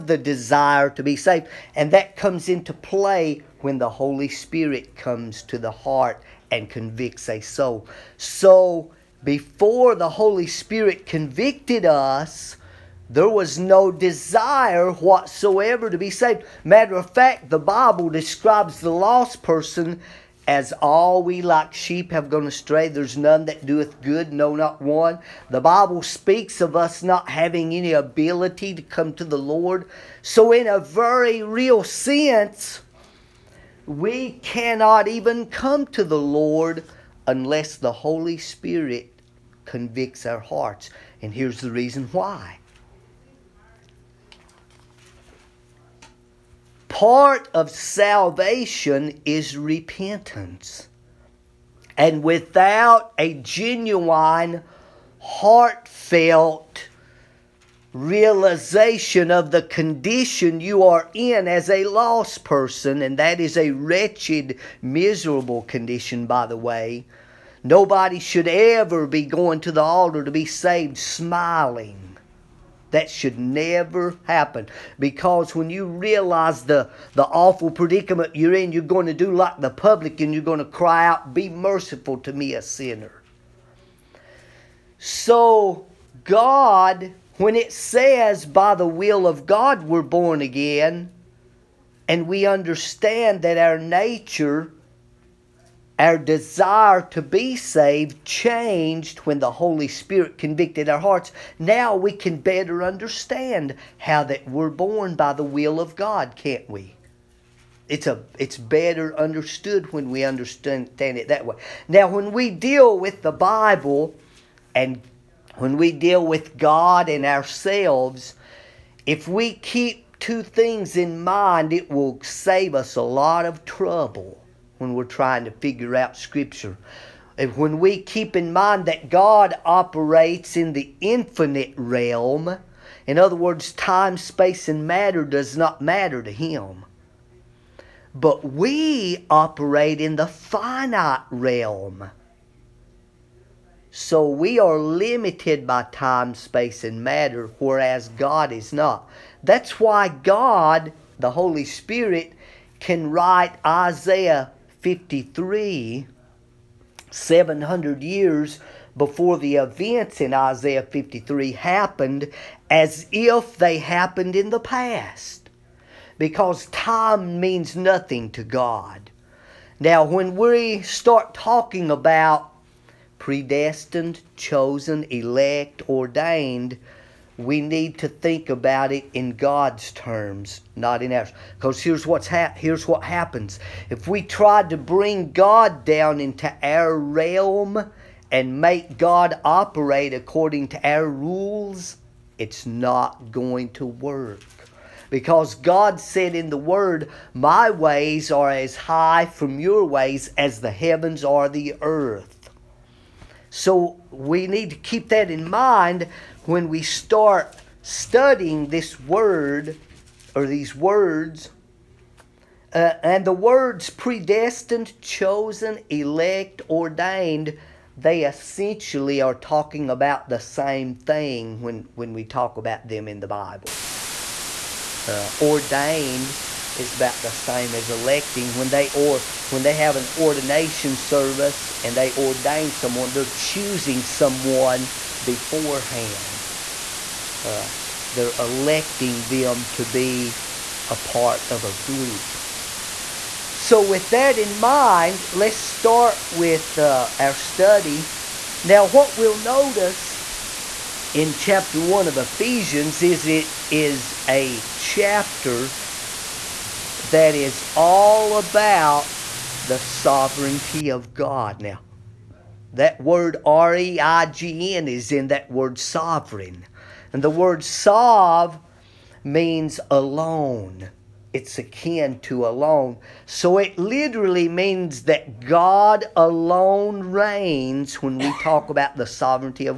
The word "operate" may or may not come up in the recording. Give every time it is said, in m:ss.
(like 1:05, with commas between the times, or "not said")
2:09, 2:19, 3:09.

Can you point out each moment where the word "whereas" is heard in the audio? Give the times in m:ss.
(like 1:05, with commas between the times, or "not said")
2:27.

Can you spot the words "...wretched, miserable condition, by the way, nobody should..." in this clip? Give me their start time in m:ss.
1:03.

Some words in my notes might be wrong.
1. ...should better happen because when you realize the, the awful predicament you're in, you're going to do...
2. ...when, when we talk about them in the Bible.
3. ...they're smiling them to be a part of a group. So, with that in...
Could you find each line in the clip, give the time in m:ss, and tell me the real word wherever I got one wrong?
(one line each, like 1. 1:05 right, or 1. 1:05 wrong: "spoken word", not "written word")
1. 1:13 wrong: "never", not "better"
2. 3:41 right
3. 3:58 wrong: "electing", not "smiling".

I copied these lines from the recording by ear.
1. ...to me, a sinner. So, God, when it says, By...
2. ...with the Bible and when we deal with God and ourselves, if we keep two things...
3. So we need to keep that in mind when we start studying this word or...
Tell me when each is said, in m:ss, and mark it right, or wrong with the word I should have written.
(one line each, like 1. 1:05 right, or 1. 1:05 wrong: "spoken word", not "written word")
1. 1:22 right
2. 1:52 right
3. 3:23 right.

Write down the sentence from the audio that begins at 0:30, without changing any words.
So, in a very real sense, we cannot even come to the Lord unless the Holy Spirit convicts our hearts.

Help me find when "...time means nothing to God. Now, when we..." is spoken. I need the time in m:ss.
2:46.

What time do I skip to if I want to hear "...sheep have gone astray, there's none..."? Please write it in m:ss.
0:21.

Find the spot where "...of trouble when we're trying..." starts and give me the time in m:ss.
2:03.